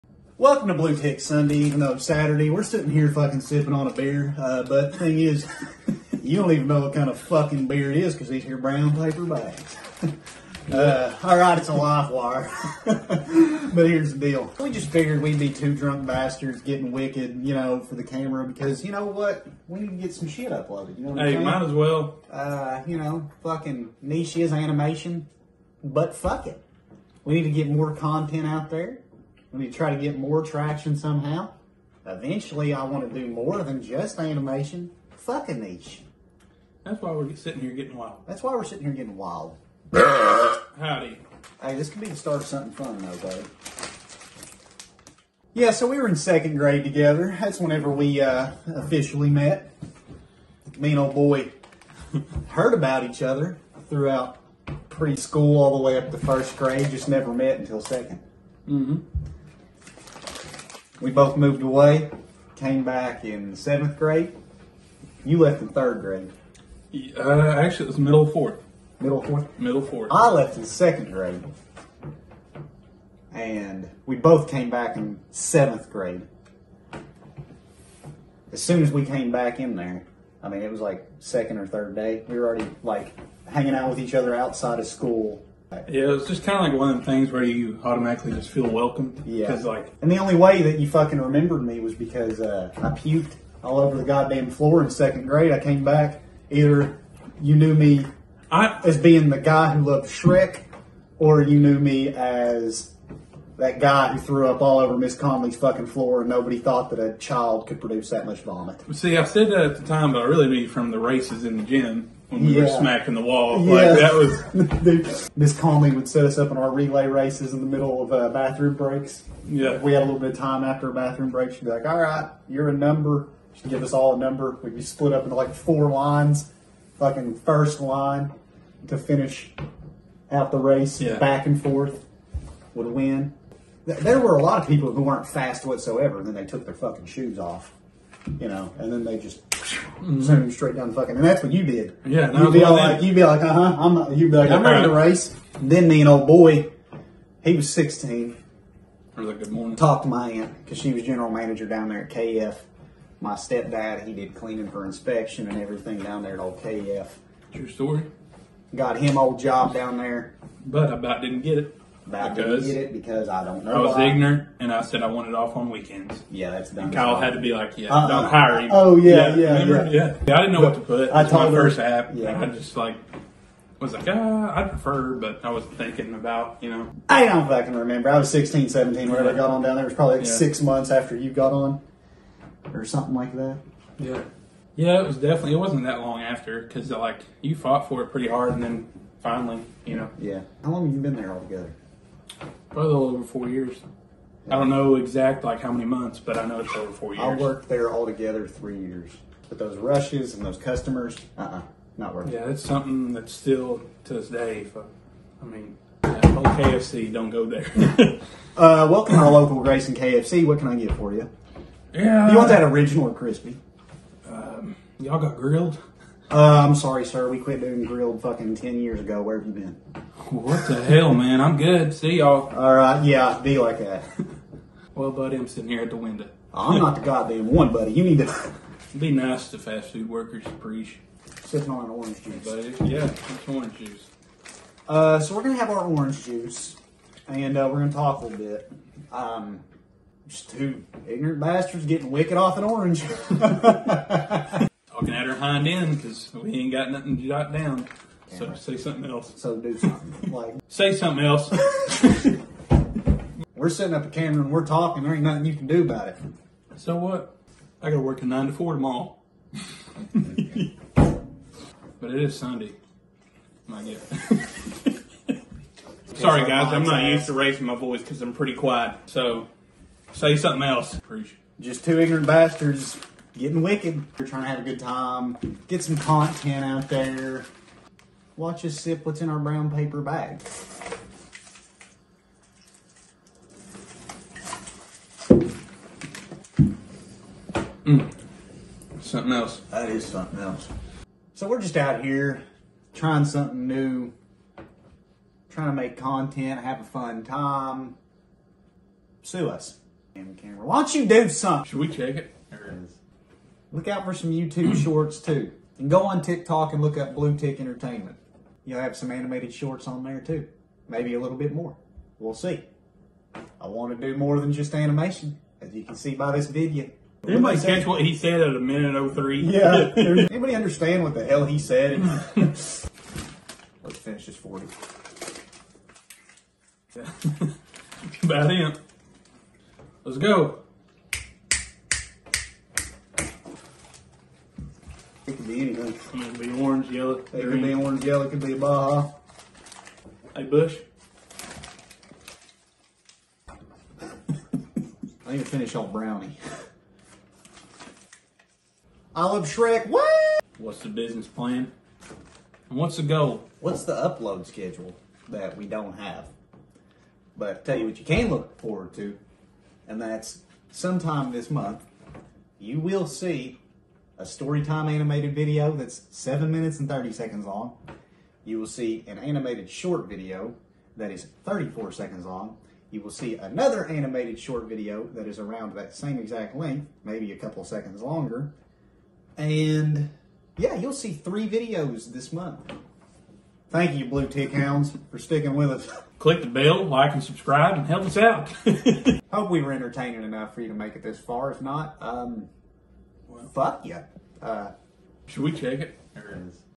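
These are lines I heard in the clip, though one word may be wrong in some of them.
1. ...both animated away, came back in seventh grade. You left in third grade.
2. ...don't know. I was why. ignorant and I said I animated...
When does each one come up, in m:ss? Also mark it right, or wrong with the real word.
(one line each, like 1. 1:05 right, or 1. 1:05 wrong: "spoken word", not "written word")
1. 1:01 wrong: "moved", not "animated"
2. 2:43 wrong: "wanted", not "animated".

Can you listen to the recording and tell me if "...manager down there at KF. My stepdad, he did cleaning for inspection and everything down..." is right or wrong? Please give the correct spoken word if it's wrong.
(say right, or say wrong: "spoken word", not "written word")
right.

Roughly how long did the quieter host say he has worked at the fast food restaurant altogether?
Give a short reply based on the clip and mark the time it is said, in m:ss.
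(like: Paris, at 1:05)
a little over four years, at 3:12.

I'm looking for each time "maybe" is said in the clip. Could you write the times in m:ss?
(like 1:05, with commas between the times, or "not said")
5:10, 6:17.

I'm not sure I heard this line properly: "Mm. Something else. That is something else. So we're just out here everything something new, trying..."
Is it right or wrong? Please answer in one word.
wrong.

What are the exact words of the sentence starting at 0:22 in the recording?
Uh, you know, fucking niche is animation, but fuck it.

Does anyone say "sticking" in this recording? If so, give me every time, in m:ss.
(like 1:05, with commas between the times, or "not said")
6:25.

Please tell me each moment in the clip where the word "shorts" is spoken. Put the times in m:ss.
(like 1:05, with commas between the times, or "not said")
5:04, 5:09, 6:09, 6:14.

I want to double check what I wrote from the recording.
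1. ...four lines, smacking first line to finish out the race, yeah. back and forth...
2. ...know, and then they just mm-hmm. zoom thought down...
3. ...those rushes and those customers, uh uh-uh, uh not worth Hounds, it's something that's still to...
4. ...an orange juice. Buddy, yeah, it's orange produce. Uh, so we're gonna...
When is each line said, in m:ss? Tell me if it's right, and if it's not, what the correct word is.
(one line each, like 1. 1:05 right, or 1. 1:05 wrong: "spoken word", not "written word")
1. 2:05 wrong: "fucking", not "smacking"
2. 2:18 wrong: "straight", not "thought"
3. 3:19 wrong: "Yeah", not "Hounds"
4. 3:51 wrong: "juice", not "produce".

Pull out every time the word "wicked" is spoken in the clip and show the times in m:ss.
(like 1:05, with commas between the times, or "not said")
0:16, 4:02, 4:33.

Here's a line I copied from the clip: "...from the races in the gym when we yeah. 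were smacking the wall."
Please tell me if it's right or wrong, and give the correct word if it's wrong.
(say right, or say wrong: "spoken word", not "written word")
right.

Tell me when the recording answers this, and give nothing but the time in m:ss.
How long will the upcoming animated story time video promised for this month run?
6:06.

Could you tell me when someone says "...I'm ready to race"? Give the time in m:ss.
2:24.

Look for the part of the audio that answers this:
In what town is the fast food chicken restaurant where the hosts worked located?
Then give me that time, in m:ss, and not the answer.
3:29.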